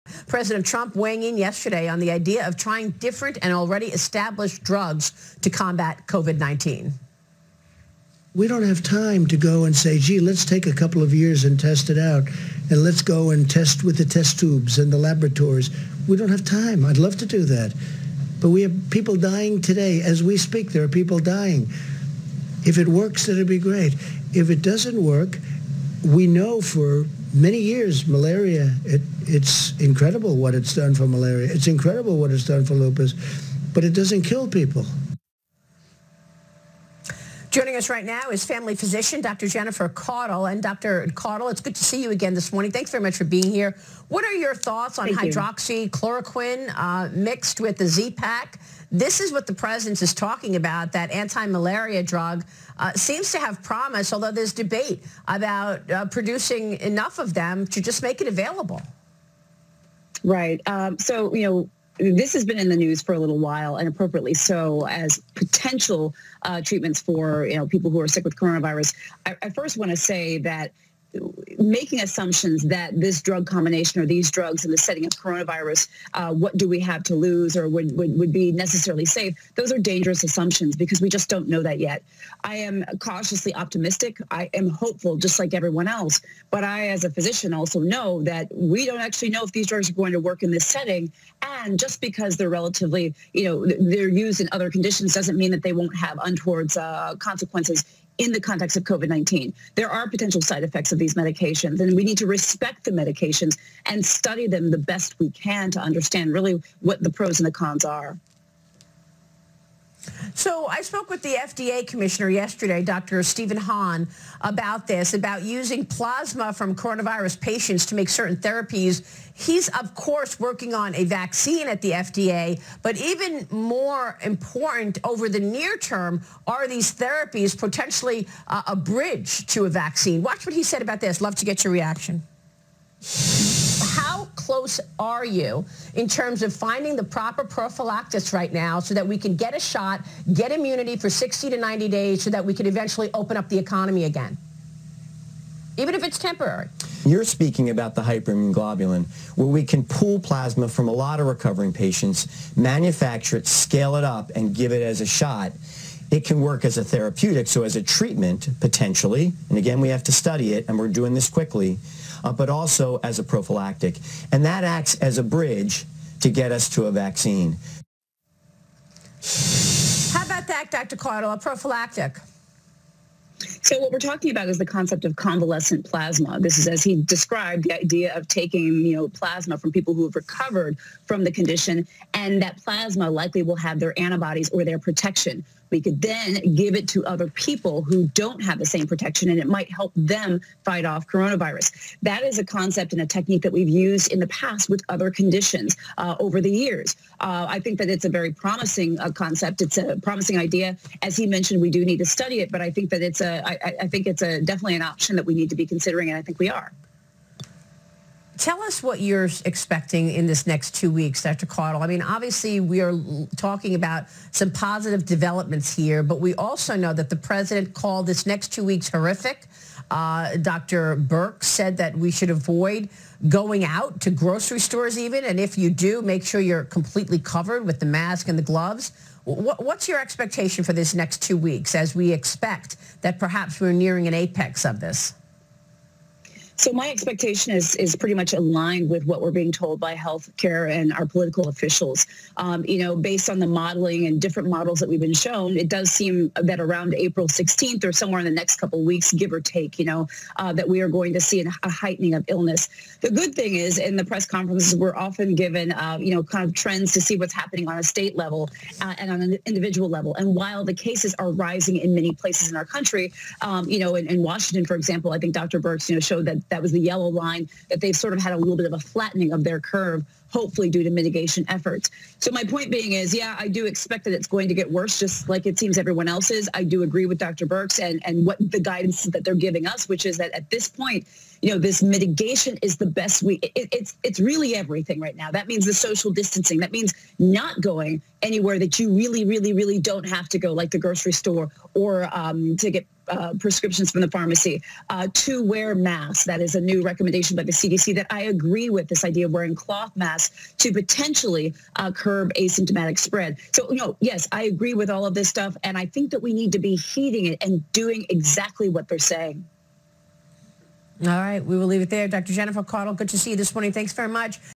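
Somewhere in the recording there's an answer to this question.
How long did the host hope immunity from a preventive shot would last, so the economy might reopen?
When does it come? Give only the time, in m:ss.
2:21.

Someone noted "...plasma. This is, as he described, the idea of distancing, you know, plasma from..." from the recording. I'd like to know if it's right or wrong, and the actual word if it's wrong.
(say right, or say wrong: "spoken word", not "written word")
wrong: "taking", not "distancing".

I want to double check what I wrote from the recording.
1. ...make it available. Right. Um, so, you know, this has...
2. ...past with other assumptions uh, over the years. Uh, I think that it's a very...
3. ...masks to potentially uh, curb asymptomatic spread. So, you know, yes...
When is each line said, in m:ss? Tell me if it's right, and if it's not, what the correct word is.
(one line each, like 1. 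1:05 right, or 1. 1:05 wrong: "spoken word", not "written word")
1. 0:58 right
2. 3:14 wrong: "conditions", not "assumptions"
3. 4:59 right.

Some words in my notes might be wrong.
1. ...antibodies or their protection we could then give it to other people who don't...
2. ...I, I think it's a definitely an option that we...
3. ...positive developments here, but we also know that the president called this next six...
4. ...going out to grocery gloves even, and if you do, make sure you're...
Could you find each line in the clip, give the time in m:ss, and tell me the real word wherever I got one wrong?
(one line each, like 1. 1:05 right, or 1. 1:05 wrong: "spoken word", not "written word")
1. 3:03 right
2. 3:23 right
3. 3:34 wrong: "two", not "six"
4. 3:43 wrong: "stores", not "gloves".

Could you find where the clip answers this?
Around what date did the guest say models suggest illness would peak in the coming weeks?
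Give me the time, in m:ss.
4:06.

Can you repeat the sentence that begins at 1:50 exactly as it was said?
So I spoke with the FDA commissioner yesterday, Dr.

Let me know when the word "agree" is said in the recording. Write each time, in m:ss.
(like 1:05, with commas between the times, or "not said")
4:36, 4:58, 5:04.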